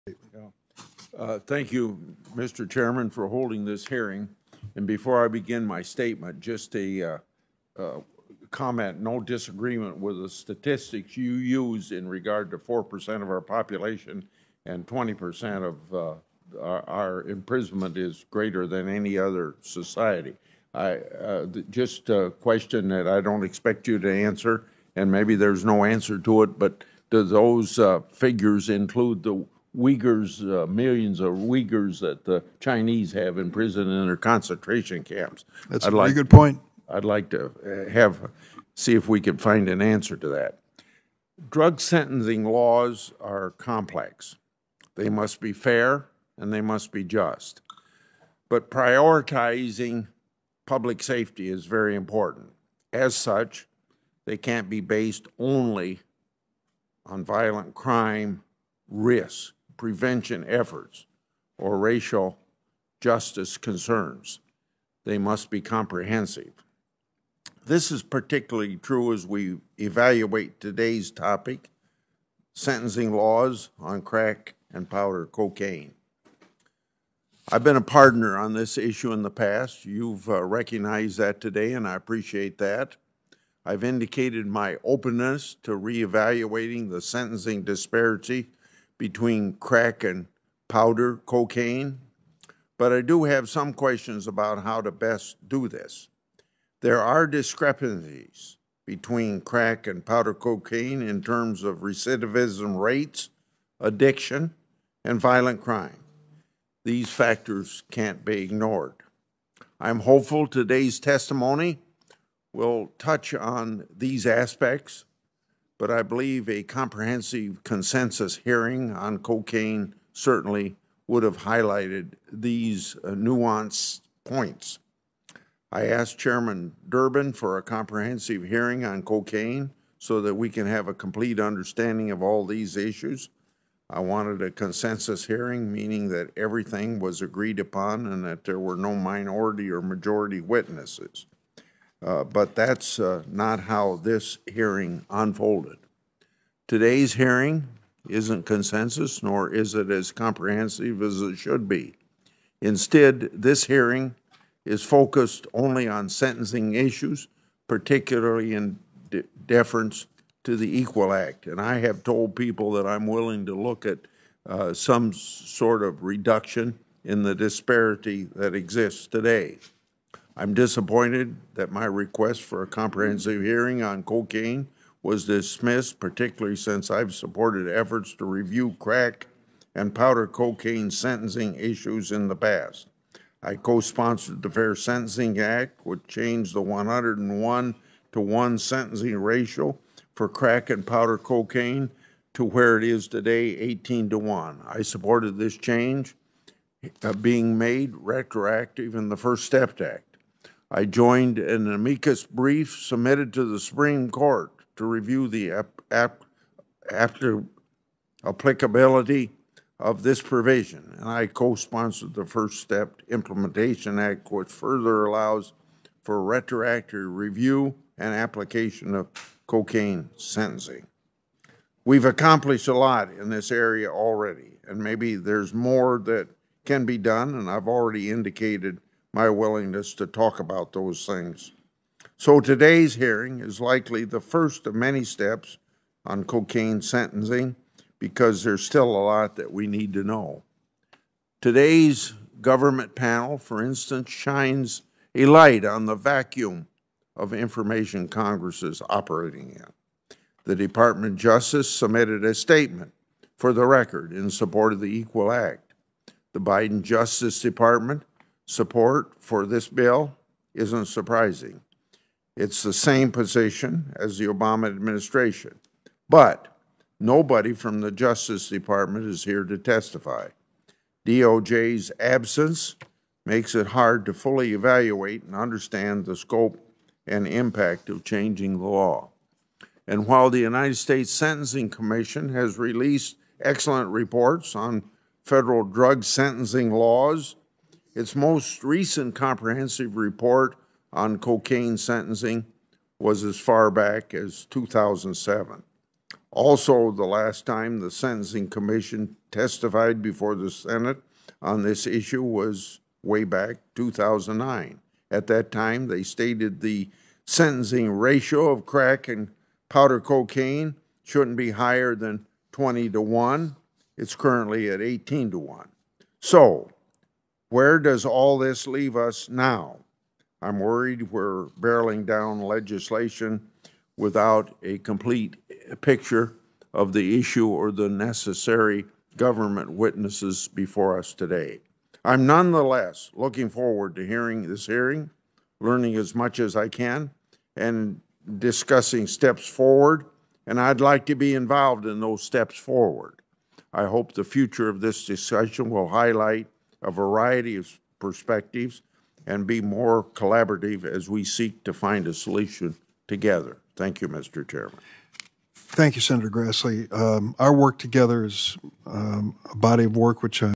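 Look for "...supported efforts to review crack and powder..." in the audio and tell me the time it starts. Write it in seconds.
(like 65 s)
177 s.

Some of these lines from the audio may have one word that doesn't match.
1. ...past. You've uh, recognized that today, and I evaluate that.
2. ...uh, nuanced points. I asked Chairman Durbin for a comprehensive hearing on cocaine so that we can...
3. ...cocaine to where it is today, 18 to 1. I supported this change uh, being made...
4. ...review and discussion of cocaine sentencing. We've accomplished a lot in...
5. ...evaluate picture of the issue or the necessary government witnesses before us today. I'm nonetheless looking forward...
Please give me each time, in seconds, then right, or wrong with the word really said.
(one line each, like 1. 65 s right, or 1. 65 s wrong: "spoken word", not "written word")
1. 79 s wrong: "appreciate", not "evaluate"
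2. 123 s right
3. 191 s right
4. 217 s wrong: "application", not "discussion"
5. 324 s wrong: "complete", not "evaluate".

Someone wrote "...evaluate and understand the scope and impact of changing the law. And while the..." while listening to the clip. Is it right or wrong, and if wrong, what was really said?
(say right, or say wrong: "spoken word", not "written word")
right.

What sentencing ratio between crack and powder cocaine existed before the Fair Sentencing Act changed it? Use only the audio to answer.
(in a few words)
101 to 1.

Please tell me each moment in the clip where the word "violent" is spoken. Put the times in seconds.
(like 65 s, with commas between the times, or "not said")
57 s, 105 s.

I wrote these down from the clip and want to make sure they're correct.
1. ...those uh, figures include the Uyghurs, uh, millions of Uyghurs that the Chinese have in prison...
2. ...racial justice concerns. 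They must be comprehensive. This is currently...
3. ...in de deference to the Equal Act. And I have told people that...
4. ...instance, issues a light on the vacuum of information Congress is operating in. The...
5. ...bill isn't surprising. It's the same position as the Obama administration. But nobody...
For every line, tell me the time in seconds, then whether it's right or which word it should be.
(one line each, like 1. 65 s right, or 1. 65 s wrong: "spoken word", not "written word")
1. 27 s right
2. 61 s wrong: "particularly", not "currently"
3. 158 s right
4. 243 s wrong: "shines", not "issues"
5. 259 s right.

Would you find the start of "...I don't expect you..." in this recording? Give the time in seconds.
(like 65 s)
23 s.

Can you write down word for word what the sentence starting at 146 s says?
Today's hearing isn't consensus, nor is it as comprehensive as it should be.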